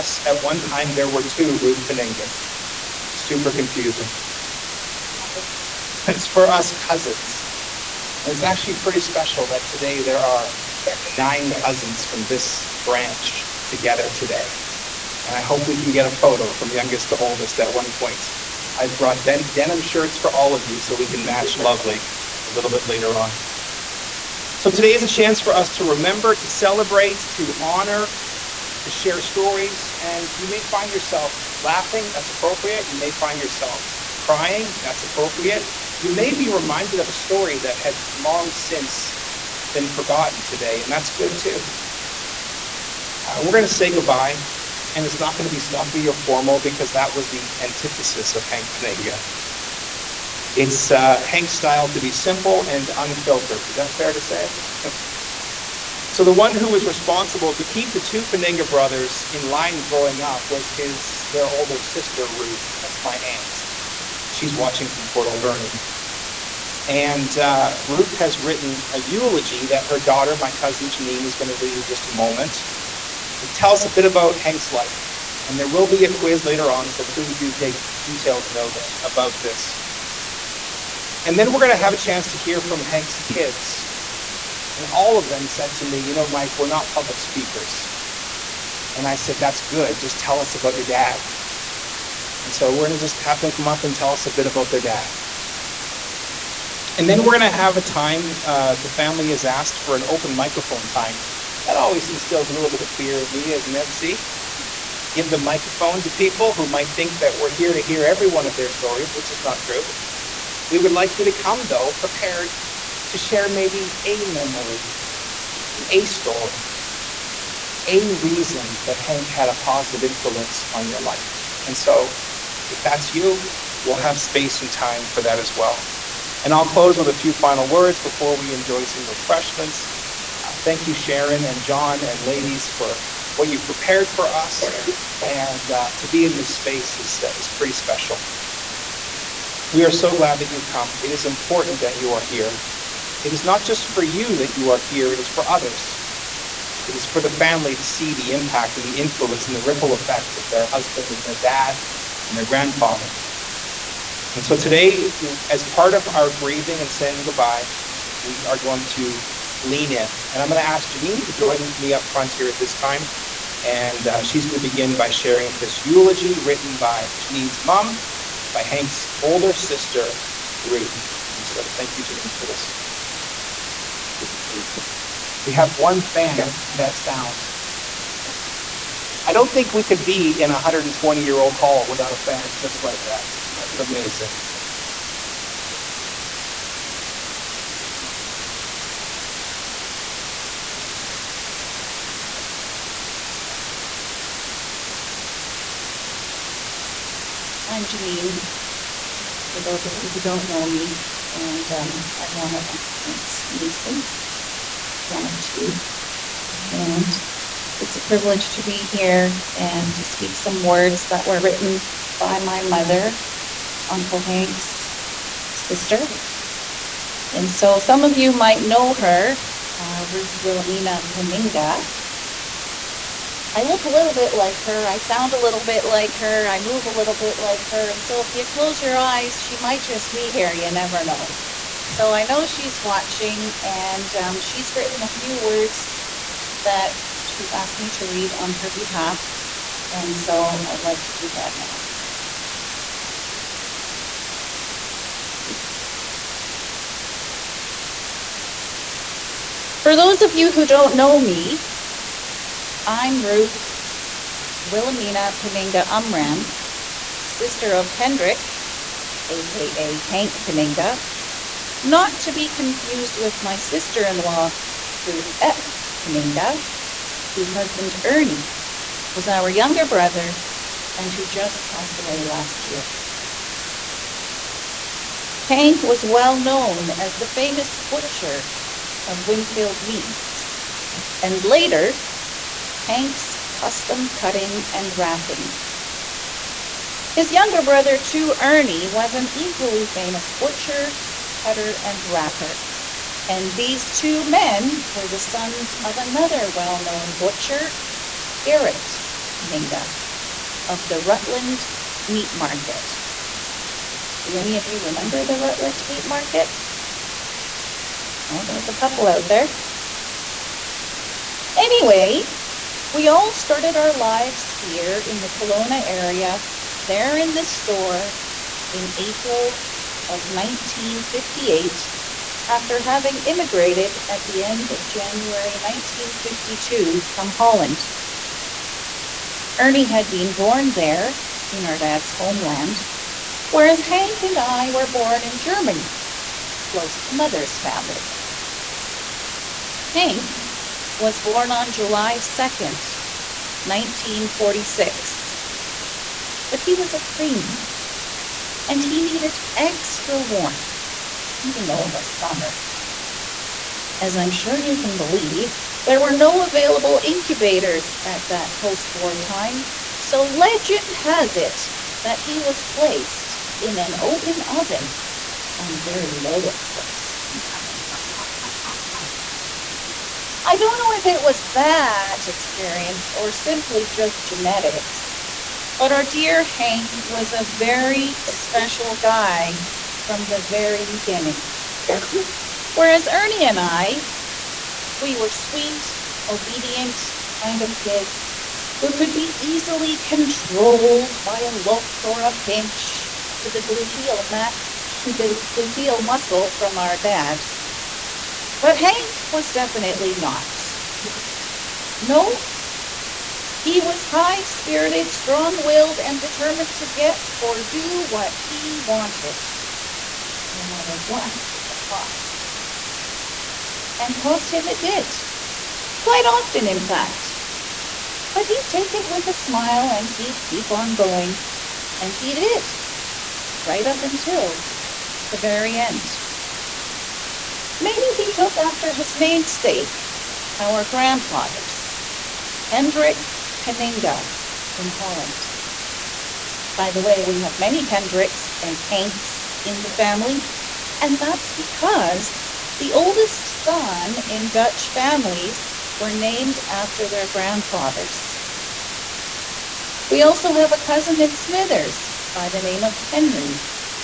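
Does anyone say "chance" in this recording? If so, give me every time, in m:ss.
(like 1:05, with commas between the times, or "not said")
0:25, 1:21.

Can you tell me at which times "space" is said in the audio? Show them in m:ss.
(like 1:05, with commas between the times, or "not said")
2:04, 2:16.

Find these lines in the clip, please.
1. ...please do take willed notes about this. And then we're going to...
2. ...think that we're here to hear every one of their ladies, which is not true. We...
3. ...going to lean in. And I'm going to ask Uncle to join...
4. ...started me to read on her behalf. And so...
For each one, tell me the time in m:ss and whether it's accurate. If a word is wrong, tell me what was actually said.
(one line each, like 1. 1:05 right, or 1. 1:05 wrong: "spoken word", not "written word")
1. 1:17 wrong: "detailed", not "willed"
2. 1:46 wrong: "stories", not "ladies"
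3. 2:38 wrong: "Janine", not "Uncle"
4. 3:57 wrong: "asked", not "started".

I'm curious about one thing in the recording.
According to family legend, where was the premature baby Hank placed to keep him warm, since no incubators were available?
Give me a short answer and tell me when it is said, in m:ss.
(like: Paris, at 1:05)
an open oven, at 6:03.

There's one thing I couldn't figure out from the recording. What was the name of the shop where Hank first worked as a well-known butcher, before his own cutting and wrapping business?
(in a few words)
Winfield Meats.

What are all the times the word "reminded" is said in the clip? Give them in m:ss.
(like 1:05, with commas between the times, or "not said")
0:36.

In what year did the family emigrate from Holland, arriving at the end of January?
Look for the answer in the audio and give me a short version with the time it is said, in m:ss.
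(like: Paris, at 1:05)
1952, at 5:25.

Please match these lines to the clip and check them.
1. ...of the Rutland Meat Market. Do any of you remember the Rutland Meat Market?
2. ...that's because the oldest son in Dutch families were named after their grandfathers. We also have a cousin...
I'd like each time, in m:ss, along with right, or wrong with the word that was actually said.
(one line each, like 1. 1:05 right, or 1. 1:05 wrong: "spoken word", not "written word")
1. 5:00 right
2. 7:21 right.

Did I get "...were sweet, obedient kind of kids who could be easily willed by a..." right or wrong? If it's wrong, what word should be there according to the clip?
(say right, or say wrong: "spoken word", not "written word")
wrong: "controlled", not "willed".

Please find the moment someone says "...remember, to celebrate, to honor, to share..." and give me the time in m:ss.
0:25.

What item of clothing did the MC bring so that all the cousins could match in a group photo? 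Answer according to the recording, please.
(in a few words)
denim shirts.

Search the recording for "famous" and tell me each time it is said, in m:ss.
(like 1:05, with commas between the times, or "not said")
4:37, 4:49.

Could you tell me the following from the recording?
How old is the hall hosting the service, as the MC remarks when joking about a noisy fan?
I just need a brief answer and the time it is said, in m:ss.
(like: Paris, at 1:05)
120 years, at 3:00.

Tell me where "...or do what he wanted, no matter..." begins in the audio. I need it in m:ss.
6:47.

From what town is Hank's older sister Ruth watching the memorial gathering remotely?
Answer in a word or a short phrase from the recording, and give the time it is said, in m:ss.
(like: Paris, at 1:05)
Port Alberni, at 1:05.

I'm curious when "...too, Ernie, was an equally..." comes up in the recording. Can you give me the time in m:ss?
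4:47.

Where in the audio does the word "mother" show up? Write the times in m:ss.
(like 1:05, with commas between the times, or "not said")
3:32, 5:37.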